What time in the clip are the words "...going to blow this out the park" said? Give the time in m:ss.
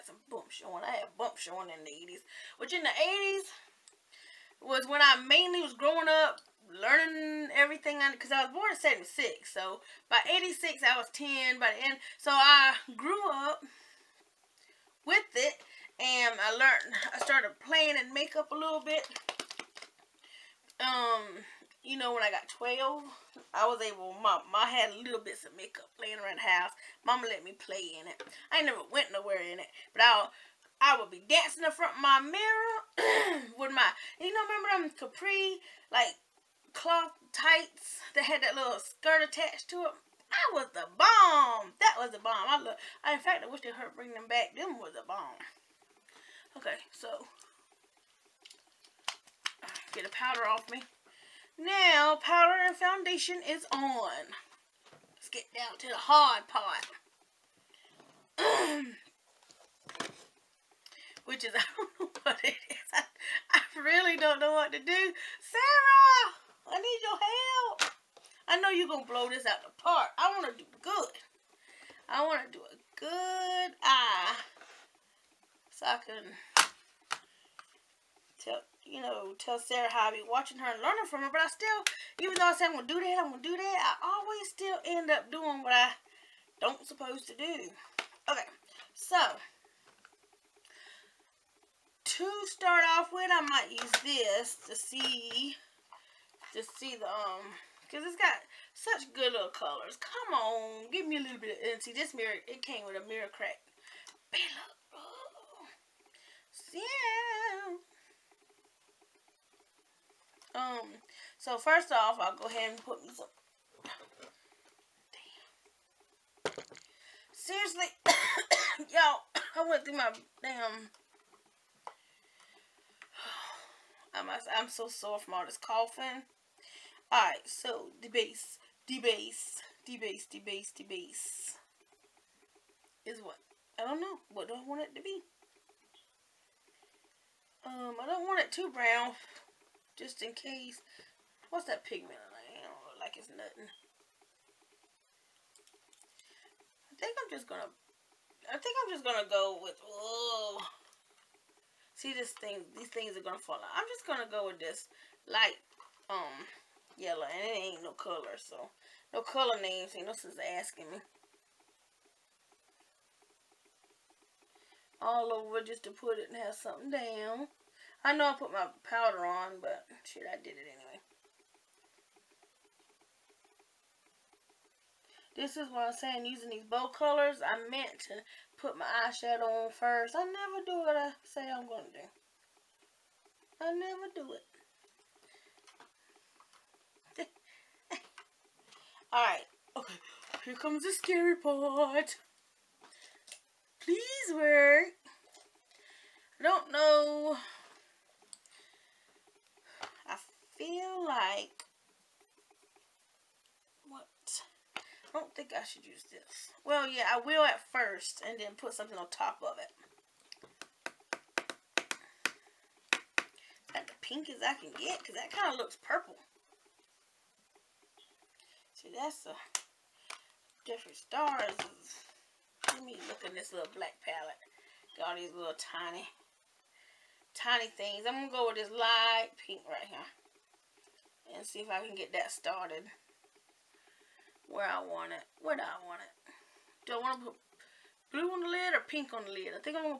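1:08.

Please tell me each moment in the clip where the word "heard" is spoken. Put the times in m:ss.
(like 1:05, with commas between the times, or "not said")
0:43.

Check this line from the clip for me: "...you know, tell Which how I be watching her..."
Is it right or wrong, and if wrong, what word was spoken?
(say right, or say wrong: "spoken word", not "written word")
wrong: "Sarah", not "Which".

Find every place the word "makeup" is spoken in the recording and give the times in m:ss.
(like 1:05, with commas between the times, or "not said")
0:18, 0:25.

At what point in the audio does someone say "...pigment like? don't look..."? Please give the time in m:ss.
2:21.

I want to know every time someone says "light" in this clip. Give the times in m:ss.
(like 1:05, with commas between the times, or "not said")
2:35, 3:48.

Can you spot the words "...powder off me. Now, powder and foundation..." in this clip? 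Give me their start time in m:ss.
0:50.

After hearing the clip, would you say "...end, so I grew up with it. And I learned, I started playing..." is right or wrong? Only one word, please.
right.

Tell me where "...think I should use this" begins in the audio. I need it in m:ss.
3:25.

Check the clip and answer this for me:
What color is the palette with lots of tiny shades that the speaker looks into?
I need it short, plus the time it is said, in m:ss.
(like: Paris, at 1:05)
black, at 3:43.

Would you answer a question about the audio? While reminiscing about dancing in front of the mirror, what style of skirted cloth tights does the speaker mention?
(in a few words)
capri.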